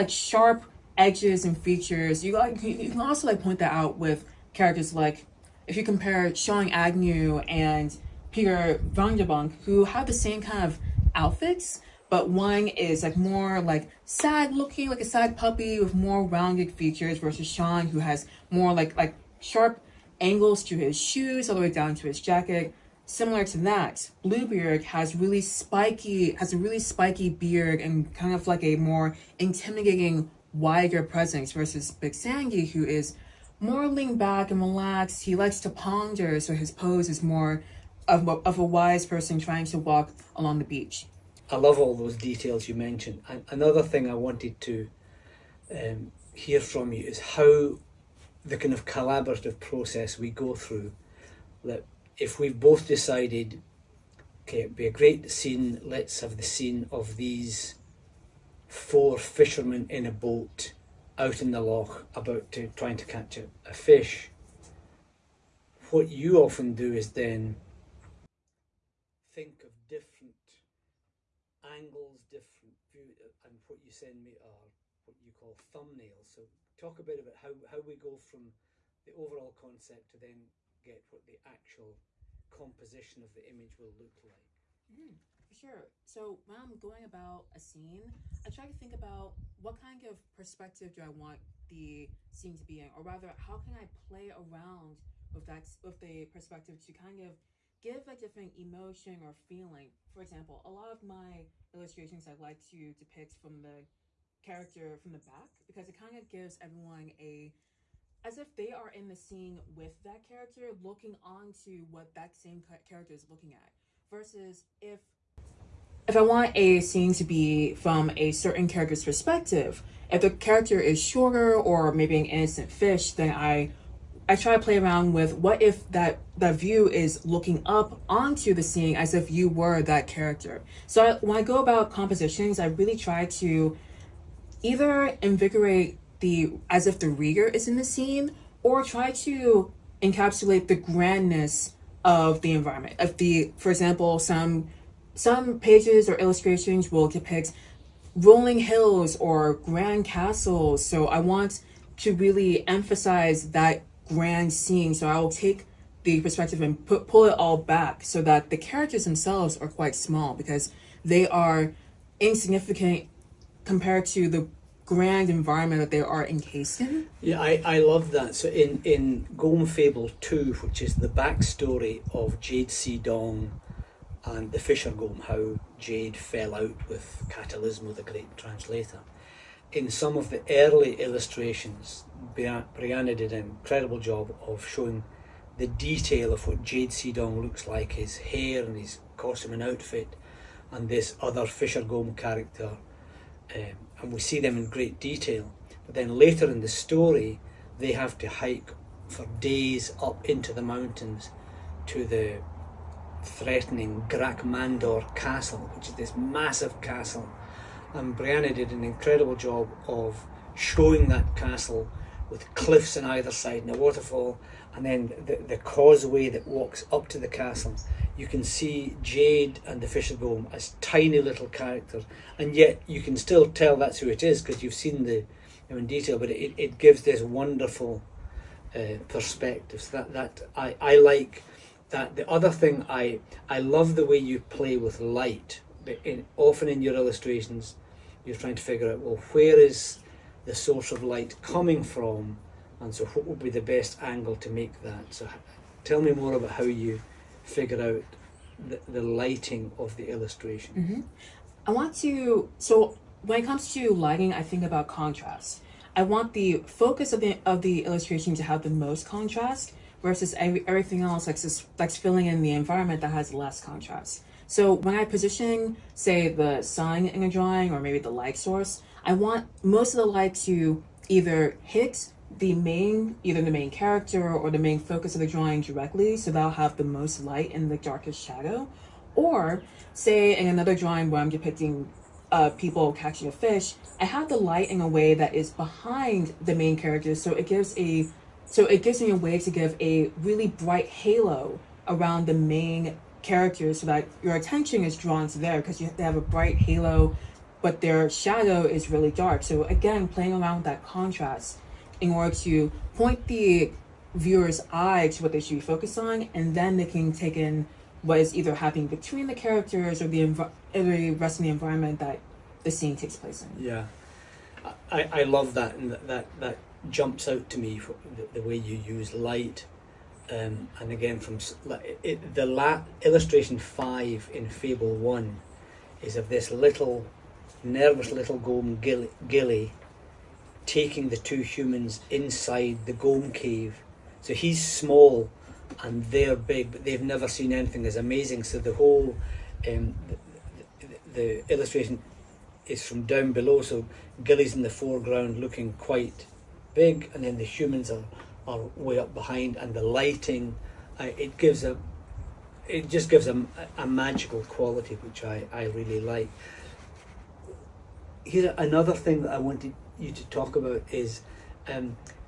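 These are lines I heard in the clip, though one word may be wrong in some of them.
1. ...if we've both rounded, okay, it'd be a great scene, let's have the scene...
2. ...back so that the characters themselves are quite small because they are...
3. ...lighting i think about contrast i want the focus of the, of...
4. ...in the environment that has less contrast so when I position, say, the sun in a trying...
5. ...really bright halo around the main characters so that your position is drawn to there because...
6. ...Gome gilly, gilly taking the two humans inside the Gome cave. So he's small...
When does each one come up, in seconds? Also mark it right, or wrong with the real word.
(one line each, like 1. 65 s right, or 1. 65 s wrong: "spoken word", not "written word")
1. 52 s wrong: "decided", not "rounded"
2. 157 s right
3. 253 s right
4. 262 s wrong: "drawing", not "trying"
5. 290 s wrong: "attention", not "position"
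6. 328 s right.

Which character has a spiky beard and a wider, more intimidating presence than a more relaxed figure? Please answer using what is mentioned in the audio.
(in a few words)
Bluebeard.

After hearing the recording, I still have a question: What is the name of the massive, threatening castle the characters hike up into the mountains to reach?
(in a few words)
Grakmandor castle.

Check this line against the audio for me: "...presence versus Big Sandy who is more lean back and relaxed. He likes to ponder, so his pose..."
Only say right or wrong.
right.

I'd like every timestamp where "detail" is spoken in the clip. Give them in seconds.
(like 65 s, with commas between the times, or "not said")
42 s, 185 s, 195 s, 225 s.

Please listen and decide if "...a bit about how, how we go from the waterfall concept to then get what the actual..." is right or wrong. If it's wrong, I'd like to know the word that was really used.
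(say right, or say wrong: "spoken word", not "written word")
wrong: "overall", not "waterfall".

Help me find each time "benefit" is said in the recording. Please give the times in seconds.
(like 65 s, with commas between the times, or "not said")
not said.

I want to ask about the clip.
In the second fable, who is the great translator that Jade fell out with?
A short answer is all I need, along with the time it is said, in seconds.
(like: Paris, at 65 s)
Catalismo, at 177 s.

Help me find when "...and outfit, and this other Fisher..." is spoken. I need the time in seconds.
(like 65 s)
189 s.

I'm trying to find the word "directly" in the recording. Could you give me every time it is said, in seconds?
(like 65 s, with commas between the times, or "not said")
275 s.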